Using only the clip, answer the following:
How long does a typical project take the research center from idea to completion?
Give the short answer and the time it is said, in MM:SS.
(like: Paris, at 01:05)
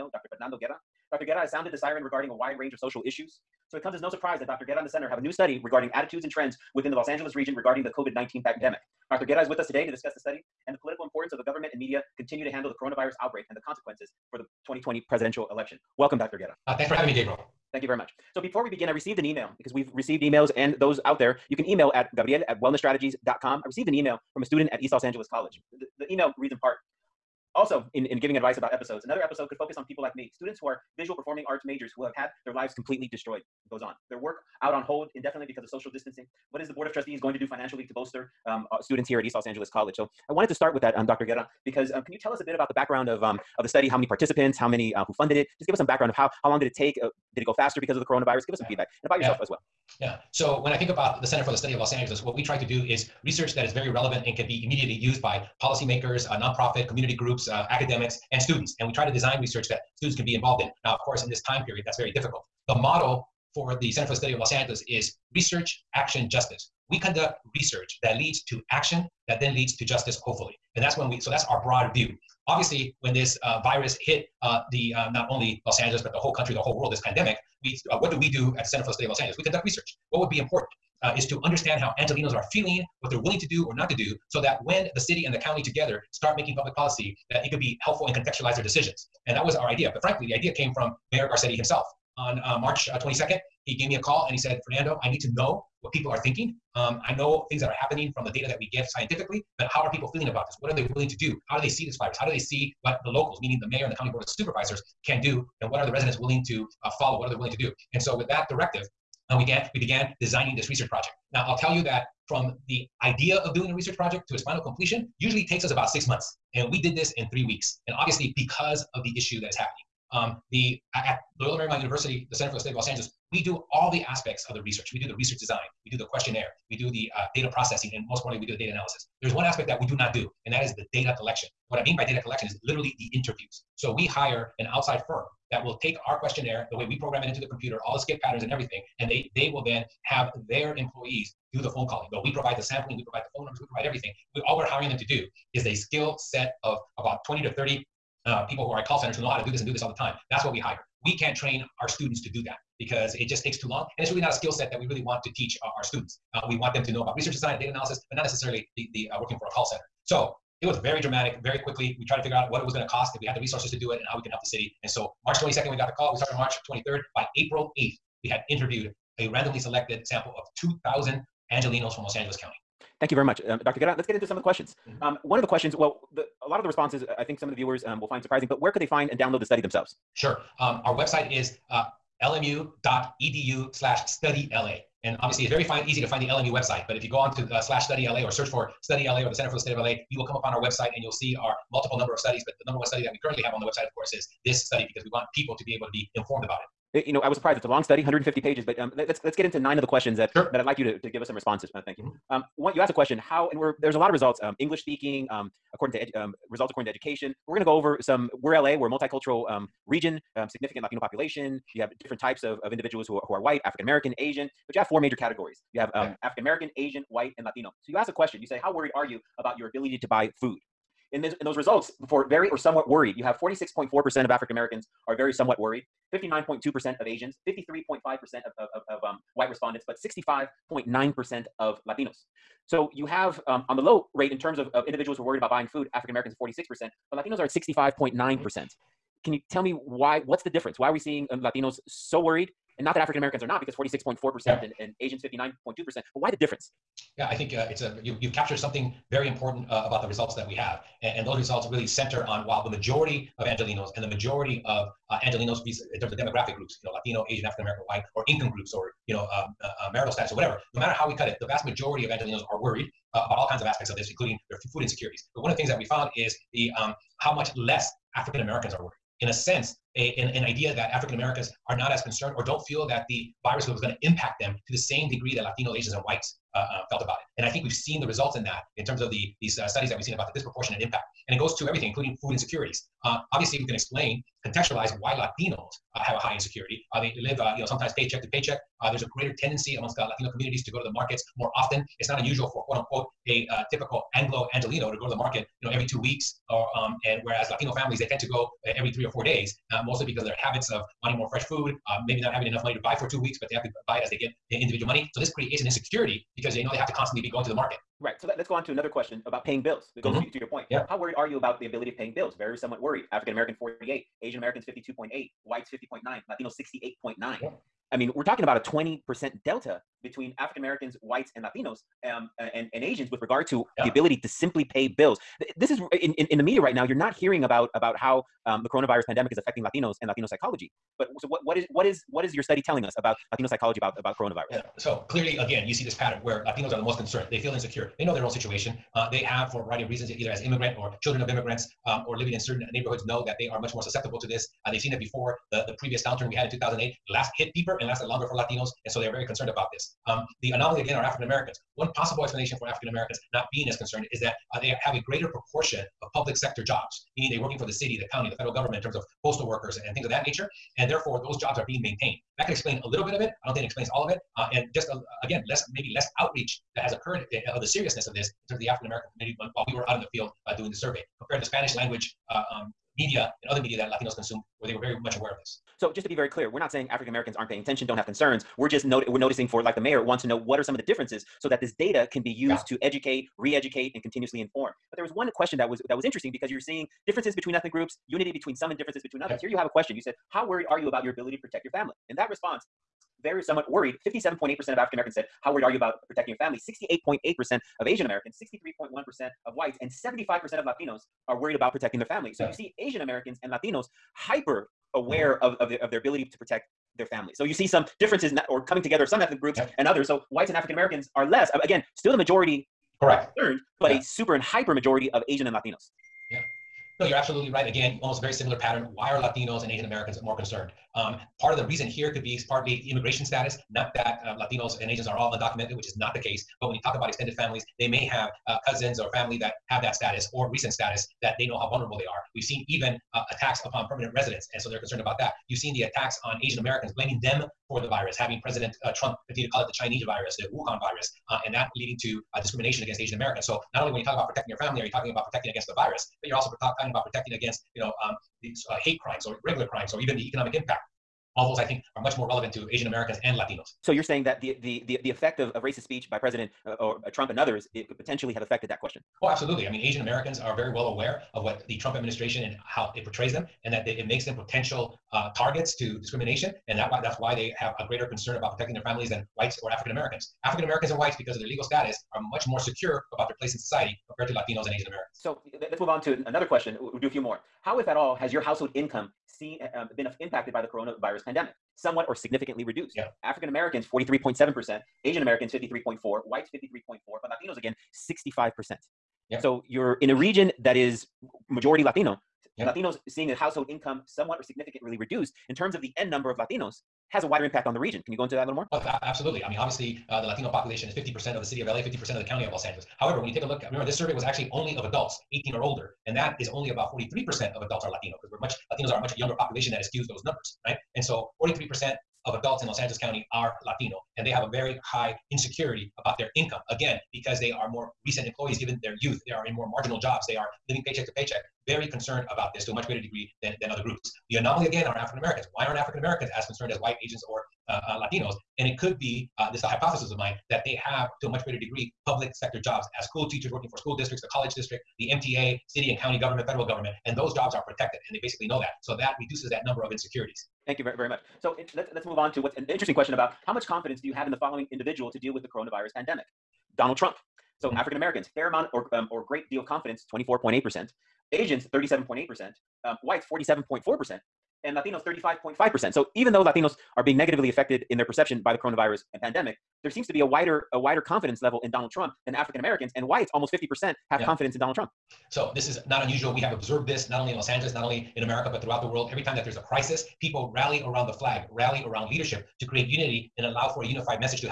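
six months, at 01:55.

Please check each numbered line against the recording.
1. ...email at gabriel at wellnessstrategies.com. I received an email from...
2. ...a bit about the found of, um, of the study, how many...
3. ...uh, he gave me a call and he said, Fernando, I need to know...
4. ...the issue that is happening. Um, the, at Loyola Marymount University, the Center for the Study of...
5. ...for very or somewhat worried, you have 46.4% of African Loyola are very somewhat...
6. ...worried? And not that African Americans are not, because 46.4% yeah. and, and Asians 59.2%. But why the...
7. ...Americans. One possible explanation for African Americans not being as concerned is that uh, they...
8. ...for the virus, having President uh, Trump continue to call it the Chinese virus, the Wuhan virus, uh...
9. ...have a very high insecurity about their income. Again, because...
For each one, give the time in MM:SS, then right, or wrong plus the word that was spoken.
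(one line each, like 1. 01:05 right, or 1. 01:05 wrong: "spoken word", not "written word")
1. 00:21 right
2. 00:42 wrong: "background", not "found"
3. 01:33 right
4. 01:59 right
5. 03:42 wrong: "Americans", not "Loyola"
6. 04:02 right
7. 05:51 right
8. 07:17 right
9. 08:34 right.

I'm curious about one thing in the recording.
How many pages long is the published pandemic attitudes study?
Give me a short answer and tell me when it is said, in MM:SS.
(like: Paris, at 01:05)
150, at 03:18.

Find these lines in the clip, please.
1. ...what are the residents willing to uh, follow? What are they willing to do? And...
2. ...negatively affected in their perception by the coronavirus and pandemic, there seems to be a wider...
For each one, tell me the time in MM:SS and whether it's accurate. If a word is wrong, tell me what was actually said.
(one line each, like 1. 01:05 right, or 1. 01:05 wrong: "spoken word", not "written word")
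1. 01:45 right
2. 09:17 right.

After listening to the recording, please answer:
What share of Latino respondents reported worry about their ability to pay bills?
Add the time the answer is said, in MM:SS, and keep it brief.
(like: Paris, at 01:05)
68.9, at 05:16.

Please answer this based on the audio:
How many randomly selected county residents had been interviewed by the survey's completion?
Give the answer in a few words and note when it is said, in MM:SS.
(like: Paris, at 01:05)
2,000, at 02:50.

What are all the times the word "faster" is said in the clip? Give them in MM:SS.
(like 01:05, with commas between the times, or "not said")
00:47.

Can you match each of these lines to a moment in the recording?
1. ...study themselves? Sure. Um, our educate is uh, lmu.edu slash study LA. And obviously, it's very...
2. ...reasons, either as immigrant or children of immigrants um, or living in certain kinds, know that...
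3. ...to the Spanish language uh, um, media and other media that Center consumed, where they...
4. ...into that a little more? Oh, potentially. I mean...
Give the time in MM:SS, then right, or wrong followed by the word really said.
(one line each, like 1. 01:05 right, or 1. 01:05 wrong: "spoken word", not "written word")
1. 02:59 wrong: "website", not "educate"
2. 05:39 wrong: "neighborhoods", not "kinds"
3. 06:11 wrong: "Latinos", not "Center"
4. 08:18 wrong: "absolutely", not "potentially".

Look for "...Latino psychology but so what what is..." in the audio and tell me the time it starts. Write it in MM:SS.
05:30.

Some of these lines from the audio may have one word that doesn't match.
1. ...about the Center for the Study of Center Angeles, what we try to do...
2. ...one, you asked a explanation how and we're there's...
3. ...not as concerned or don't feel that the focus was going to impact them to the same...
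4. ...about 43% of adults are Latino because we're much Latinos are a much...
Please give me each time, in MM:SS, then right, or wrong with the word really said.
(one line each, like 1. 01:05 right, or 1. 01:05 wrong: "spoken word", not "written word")
1. 00:50 wrong: "Los", not "Center"
2. 03:22 wrong: "question", not "explanation"
3. 04:31 wrong: "virus", not "focus"
4. 08:26 right.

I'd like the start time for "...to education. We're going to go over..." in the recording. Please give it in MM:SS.
03:26.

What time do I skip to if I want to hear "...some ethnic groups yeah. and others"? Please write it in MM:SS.
06:49.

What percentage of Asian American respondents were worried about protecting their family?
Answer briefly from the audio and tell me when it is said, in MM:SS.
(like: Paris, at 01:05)
68.8%, at 06:36.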